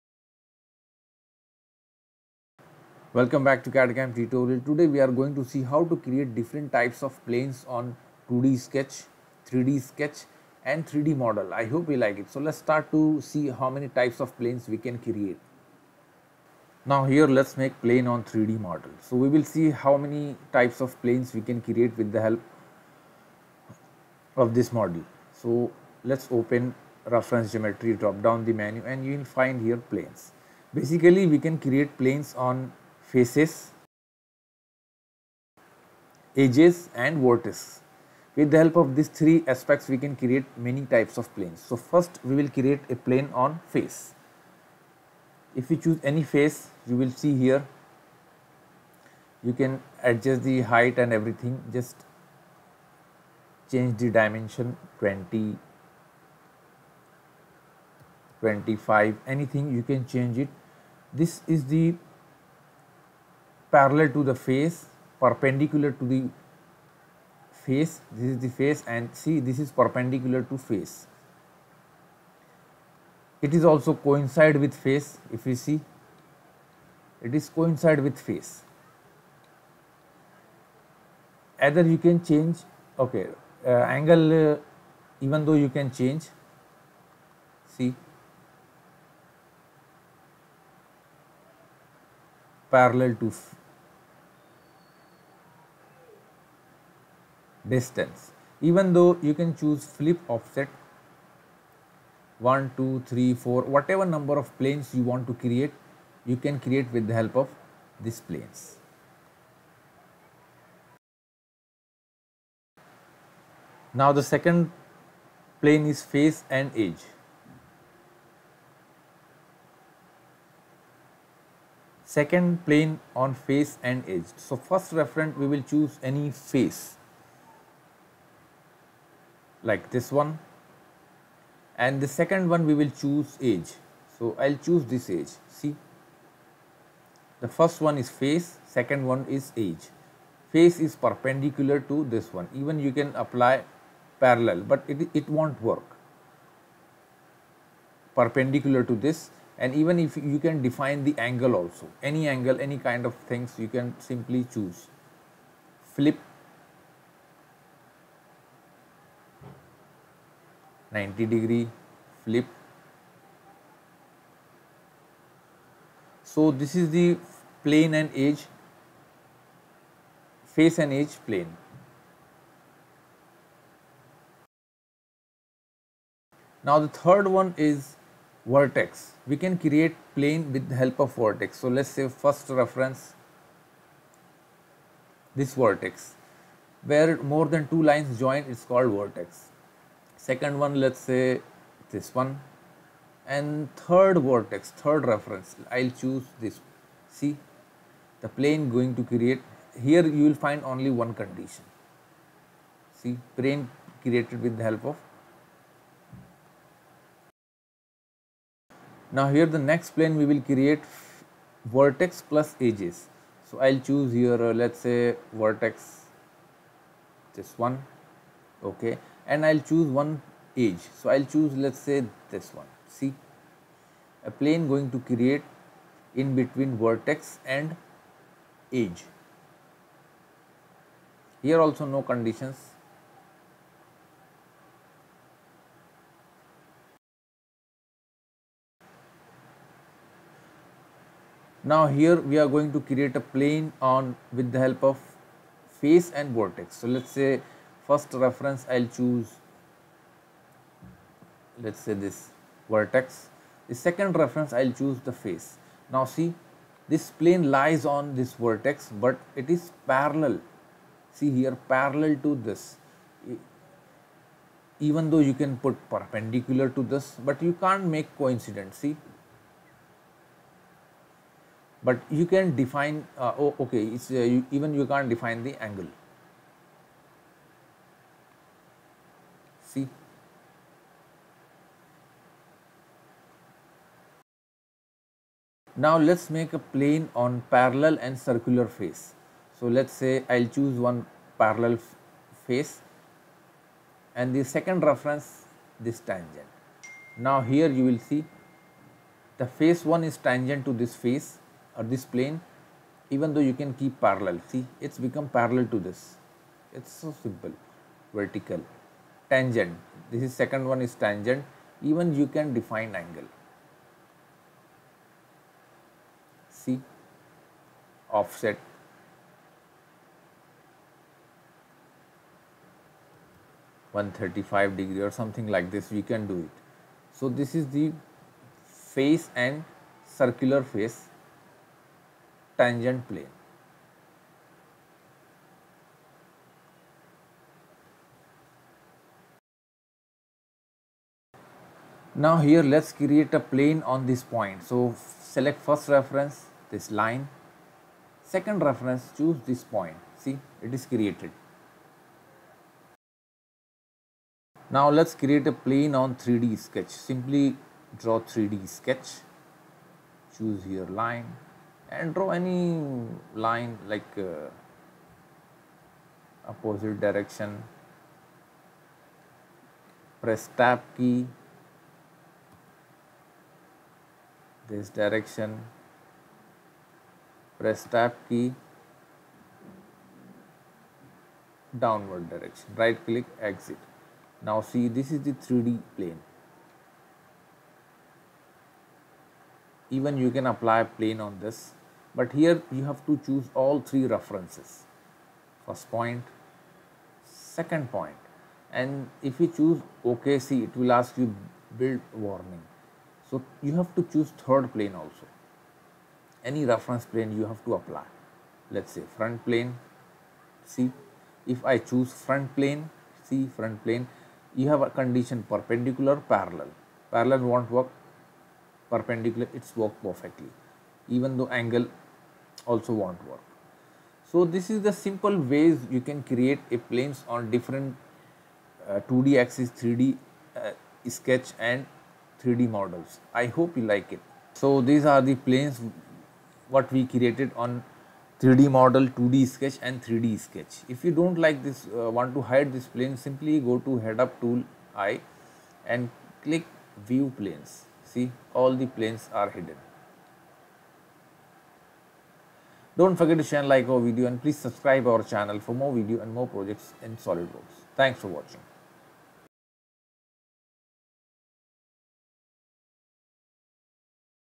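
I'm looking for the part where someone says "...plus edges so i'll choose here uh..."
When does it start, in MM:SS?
03:32.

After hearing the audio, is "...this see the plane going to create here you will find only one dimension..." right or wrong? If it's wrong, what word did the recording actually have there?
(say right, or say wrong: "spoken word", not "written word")
wrong: "condition", not "dimension".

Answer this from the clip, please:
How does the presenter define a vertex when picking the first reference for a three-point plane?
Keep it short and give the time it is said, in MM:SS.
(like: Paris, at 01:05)
Where more than two lines join, at 03:06.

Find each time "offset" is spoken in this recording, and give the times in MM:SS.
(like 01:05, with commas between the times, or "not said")
01:40, 05:18.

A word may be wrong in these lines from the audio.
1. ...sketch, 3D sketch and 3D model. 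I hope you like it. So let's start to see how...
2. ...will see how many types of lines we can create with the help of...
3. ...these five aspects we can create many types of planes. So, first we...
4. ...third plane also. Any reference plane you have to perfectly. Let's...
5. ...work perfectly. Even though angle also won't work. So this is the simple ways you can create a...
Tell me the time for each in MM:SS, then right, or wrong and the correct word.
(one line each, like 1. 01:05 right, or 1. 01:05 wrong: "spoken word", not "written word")
1. 00:08 right
2. 00:19 wrong: "planes", not "lines"
3. 00:38 wrong: "three", not "five"
4. 06:44 wrong: "apply", not "perfectly"
5. 06:59 right.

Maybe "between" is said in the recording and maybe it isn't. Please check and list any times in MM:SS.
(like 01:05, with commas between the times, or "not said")
03:46.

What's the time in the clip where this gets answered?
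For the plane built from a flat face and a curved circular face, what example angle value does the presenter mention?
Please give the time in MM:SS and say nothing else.
05:24.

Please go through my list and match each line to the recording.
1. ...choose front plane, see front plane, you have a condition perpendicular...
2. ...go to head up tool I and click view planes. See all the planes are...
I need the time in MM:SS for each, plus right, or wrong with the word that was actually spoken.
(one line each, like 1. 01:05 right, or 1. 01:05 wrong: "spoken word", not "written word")
1. 06:51 right
2. 07:23 right.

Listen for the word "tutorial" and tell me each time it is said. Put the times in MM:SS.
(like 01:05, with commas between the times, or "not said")
00:04.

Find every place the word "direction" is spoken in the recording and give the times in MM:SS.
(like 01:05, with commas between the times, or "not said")
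06:06, 06:14, 06:22.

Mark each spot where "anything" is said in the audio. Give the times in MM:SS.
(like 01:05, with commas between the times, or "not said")
00:59.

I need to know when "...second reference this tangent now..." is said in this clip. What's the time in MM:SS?
04:54.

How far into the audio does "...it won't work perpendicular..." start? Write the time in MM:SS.
02:25.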